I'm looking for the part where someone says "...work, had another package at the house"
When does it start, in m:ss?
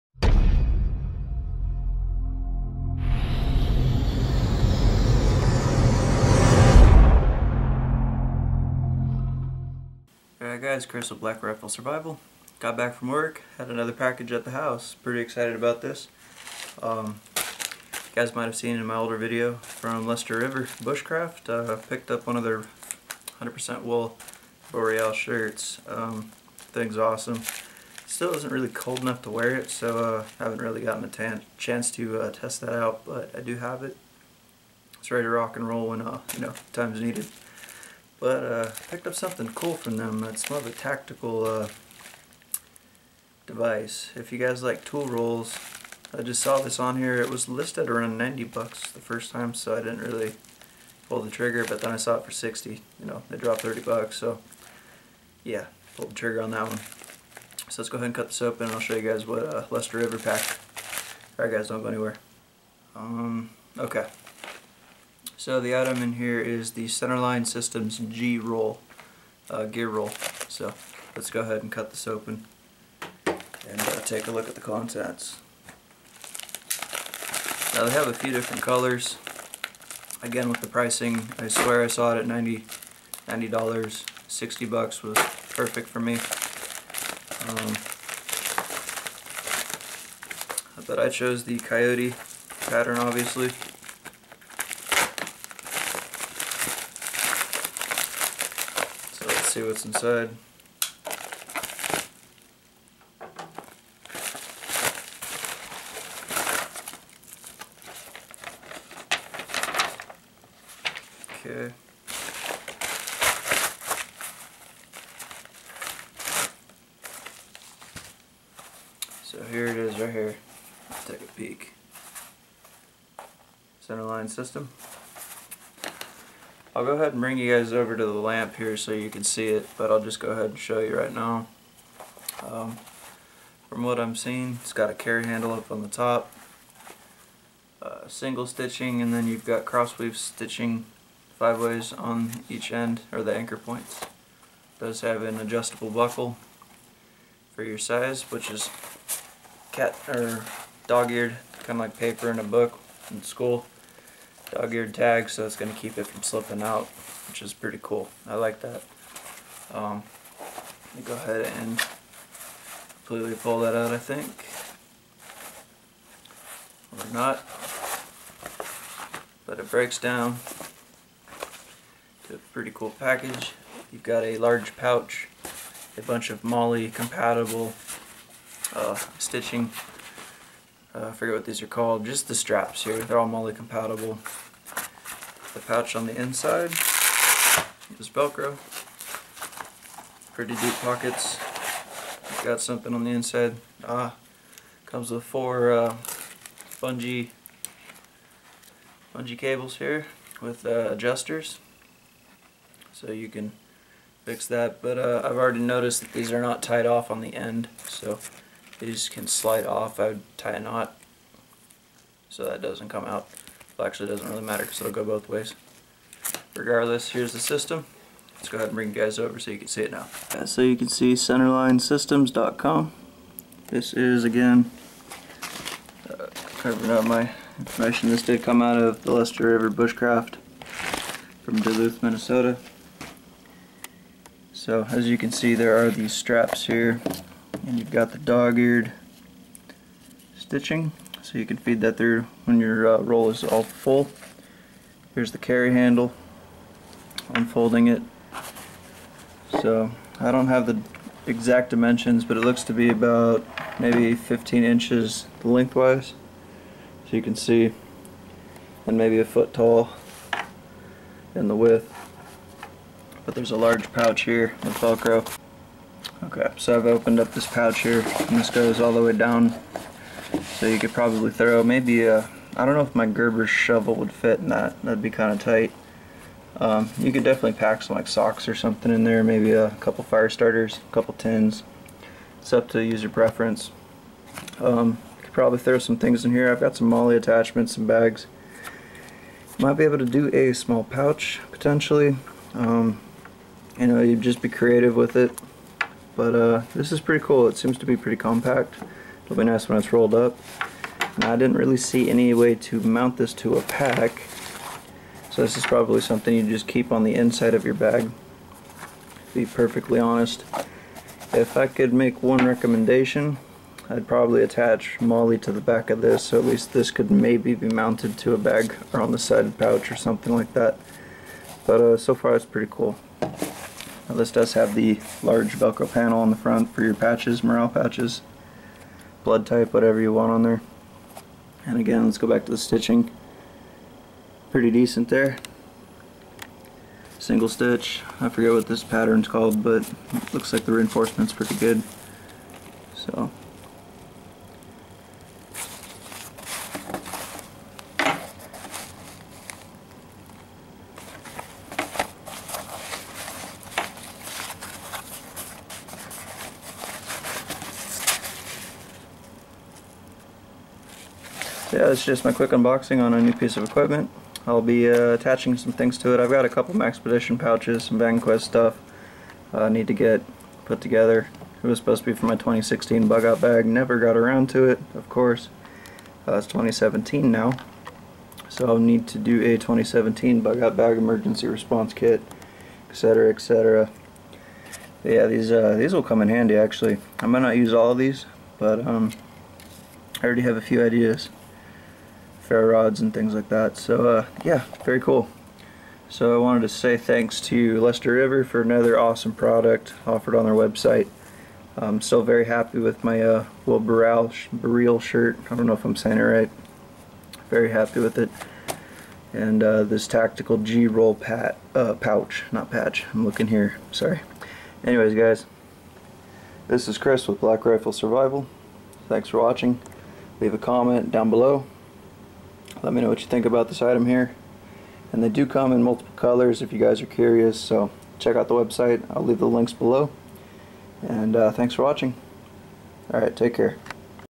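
0:13.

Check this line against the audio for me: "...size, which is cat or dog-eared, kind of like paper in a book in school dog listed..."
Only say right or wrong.
wrong.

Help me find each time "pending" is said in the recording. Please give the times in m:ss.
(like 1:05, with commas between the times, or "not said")
not said.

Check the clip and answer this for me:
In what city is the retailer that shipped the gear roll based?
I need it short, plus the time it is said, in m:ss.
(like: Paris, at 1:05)
Duluth, Minnesota, at 3:51.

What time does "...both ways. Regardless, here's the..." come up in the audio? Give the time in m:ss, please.
3:35.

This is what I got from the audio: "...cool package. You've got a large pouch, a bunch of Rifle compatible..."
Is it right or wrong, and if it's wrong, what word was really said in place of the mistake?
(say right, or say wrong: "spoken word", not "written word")
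wrong: "MOLLE", not "Rifle".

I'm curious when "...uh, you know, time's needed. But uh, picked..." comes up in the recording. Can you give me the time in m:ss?
0:36.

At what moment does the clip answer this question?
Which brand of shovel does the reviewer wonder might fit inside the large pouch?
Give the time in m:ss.
4:33.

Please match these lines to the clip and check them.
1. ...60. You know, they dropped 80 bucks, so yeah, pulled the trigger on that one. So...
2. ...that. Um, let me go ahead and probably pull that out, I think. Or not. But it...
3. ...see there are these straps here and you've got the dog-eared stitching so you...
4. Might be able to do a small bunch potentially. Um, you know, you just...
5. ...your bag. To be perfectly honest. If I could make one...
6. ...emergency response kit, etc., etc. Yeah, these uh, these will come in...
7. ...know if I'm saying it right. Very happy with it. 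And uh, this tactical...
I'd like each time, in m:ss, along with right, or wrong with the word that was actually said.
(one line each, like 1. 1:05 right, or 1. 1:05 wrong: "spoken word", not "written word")
1. 0:52 wrong: "30", not "80"
2. 2:38 wrong: "completely", not "probably"
3. 3:55 right
4. 4:49 wrong: "pouch", not "bunch"
5. 5:07 right
6. 6:20 right
7. 6:45 right.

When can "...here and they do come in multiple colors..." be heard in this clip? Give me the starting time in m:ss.
7:04.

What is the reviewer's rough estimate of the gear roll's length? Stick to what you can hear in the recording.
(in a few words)
15 inches.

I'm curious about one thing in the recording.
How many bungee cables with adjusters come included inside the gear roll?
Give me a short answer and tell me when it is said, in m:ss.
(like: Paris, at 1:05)
4, at 3:15.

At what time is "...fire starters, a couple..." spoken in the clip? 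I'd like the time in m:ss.
4:40.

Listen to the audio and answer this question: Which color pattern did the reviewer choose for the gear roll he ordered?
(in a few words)
coyote.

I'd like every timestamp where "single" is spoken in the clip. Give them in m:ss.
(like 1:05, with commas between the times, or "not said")
2:18, 5:37.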